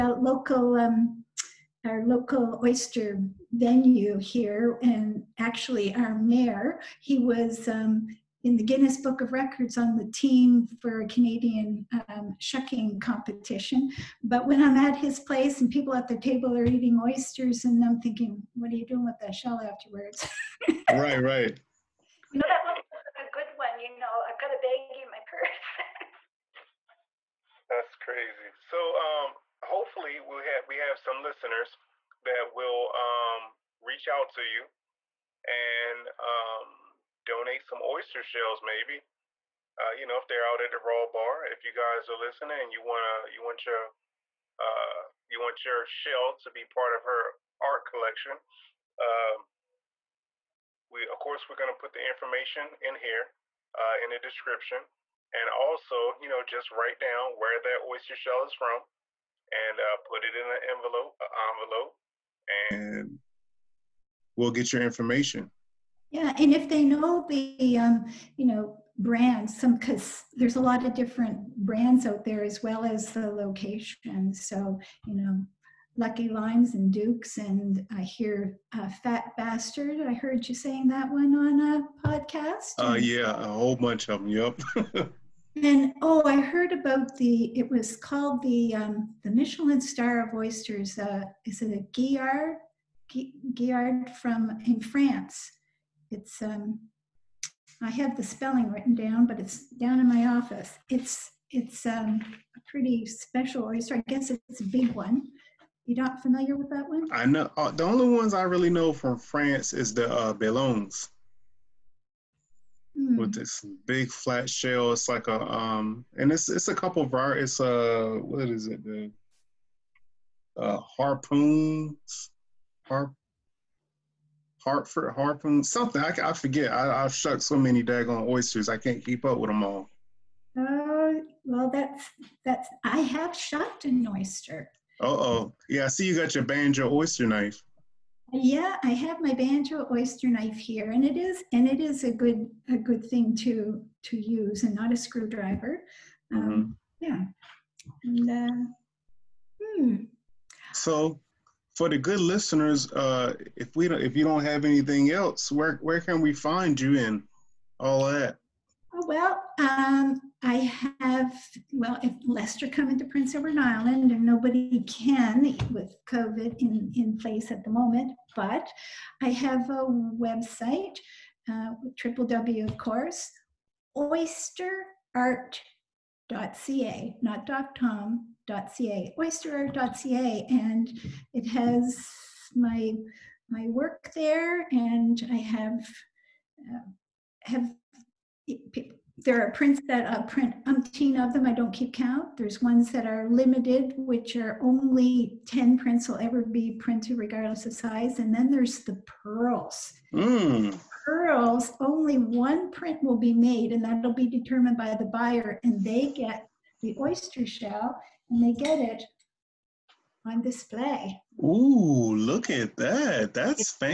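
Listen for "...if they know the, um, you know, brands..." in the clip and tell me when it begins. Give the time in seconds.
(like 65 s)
66 s.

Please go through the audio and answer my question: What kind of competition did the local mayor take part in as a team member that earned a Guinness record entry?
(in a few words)
Shucking competition.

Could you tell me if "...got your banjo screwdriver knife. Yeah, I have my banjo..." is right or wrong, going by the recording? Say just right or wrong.
wrong.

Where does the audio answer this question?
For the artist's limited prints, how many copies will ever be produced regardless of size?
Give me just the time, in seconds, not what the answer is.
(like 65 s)
195 s.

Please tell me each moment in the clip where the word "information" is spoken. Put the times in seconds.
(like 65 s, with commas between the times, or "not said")
52 s, 64 s.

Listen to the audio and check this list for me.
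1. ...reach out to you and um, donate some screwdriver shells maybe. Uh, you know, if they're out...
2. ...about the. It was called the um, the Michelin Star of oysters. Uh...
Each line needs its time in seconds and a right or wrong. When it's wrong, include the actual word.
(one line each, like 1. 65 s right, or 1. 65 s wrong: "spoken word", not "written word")
1. 33 s wrong: "oyster", not "screwdriver"
2. 86 s right.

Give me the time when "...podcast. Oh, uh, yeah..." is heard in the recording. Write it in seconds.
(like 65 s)
82 s.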